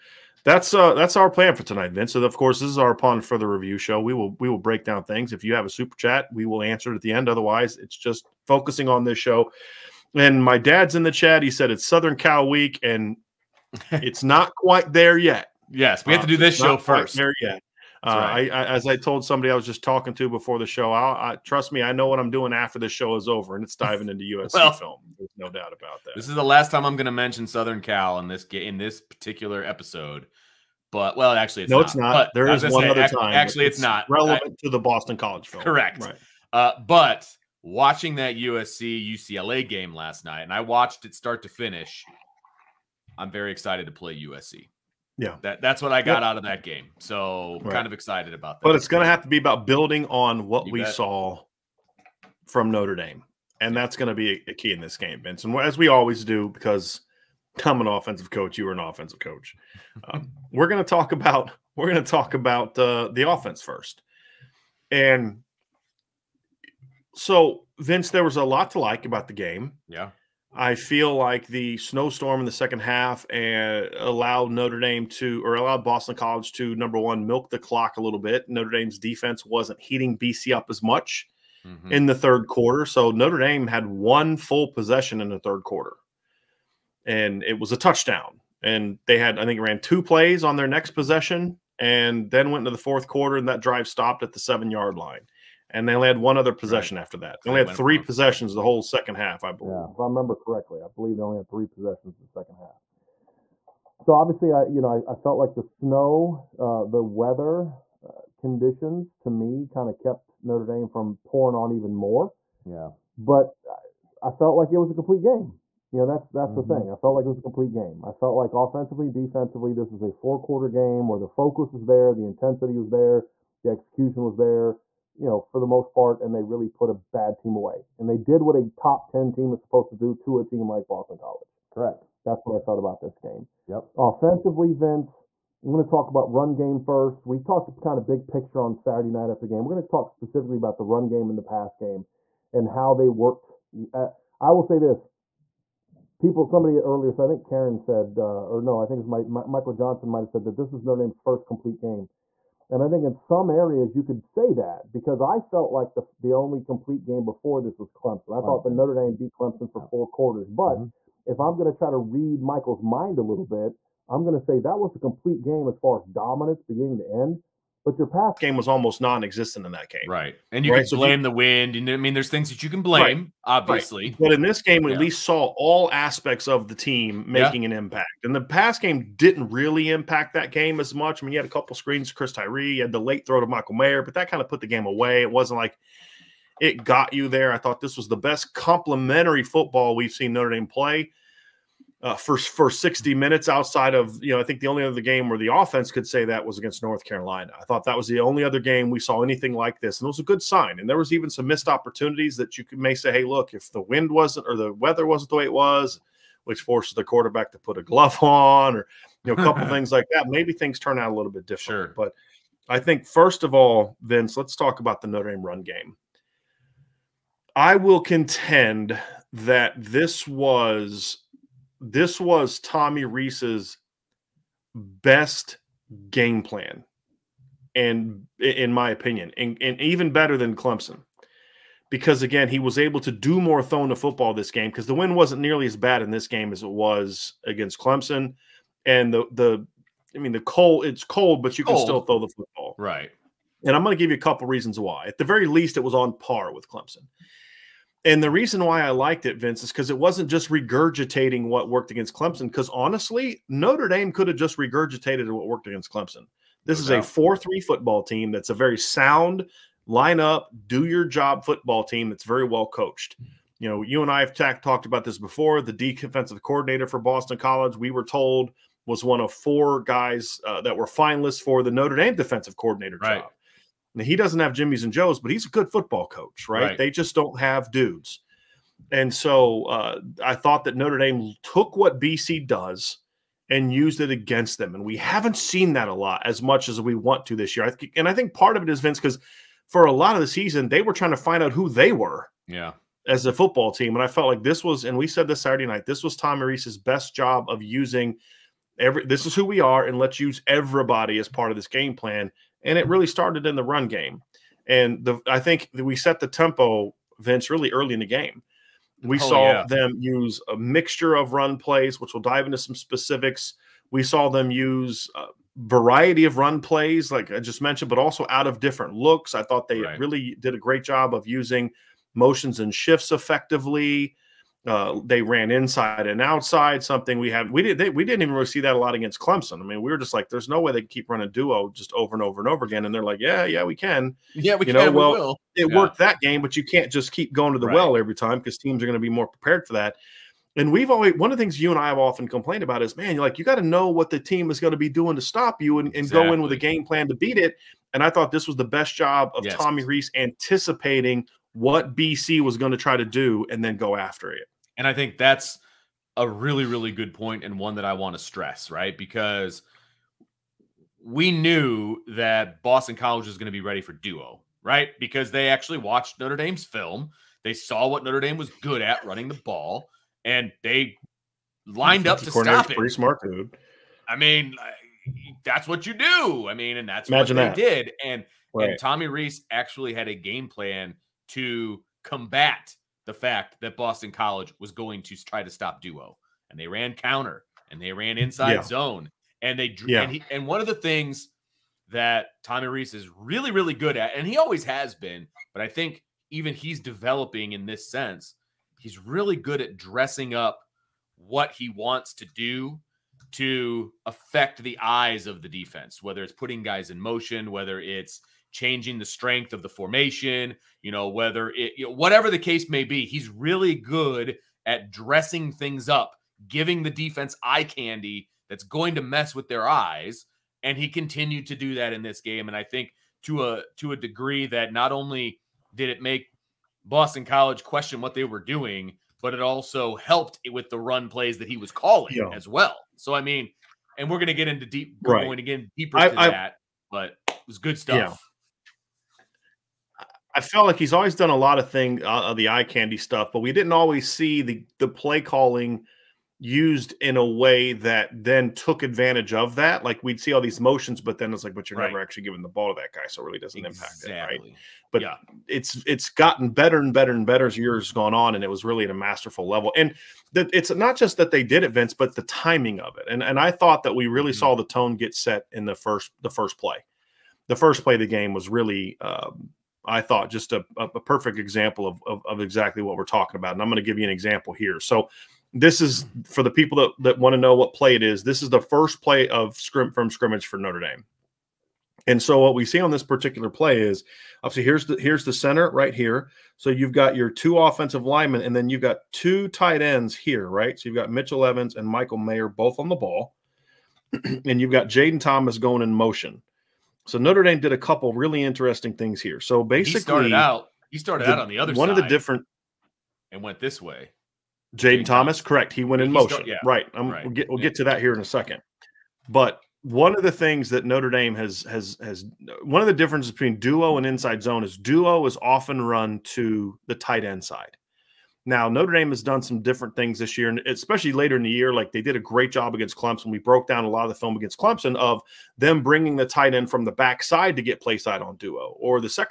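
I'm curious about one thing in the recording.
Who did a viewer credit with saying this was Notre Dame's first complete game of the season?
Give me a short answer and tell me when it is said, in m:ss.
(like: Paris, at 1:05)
Michael Johnson, at 2:29.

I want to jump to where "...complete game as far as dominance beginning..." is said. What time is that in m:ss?
2:44.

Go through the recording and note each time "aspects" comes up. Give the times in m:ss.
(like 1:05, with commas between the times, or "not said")
2:55.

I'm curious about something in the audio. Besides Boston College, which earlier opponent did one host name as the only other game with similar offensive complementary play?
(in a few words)
North Carolina.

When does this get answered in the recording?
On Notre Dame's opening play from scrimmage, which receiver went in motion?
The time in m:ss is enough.
8:14.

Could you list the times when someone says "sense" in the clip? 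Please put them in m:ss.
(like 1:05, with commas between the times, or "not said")
6:37.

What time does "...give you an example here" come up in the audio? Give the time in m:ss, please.
7:53.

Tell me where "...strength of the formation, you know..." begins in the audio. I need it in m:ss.
6:49.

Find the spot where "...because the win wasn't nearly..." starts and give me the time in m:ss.
3:54.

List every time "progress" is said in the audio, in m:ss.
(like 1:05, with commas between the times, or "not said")
not said.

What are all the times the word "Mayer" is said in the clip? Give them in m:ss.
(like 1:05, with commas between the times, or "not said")
3:03, 8:12.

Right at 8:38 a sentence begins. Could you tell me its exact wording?
Now, Notre Dame has done some different things this year, and especially later in the year.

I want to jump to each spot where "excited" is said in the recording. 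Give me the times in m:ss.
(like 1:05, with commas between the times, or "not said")
0:43, 0:47.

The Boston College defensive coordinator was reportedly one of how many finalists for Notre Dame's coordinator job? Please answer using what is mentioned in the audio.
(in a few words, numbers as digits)
4.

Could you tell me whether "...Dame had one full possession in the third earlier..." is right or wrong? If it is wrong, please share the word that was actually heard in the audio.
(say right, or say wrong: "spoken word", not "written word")
wrong: "quarter", not "earlier".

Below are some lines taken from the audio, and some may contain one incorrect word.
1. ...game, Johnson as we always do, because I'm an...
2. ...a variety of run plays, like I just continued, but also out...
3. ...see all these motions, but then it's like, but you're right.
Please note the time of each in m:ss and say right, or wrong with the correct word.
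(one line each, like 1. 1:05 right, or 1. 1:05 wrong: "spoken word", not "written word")
1. 0:54 wrong: "And", not "Johnson"
2. 5:15 wrong: "mentioned", not "continued"
3. 7:30 right.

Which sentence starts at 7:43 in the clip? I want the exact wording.
And and I thought that we really mm-hmm.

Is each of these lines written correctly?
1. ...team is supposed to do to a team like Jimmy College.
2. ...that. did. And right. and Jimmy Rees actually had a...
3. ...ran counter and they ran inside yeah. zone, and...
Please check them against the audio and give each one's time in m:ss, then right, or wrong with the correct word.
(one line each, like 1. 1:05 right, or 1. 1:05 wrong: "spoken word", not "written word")
1. 2:09 wrong: "Boston", not "Jimmy"
2. 6:17 wrong: "Tommy", not "Jimmy"
3. 6:26 right.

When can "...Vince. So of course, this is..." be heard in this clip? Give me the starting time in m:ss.
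0:01.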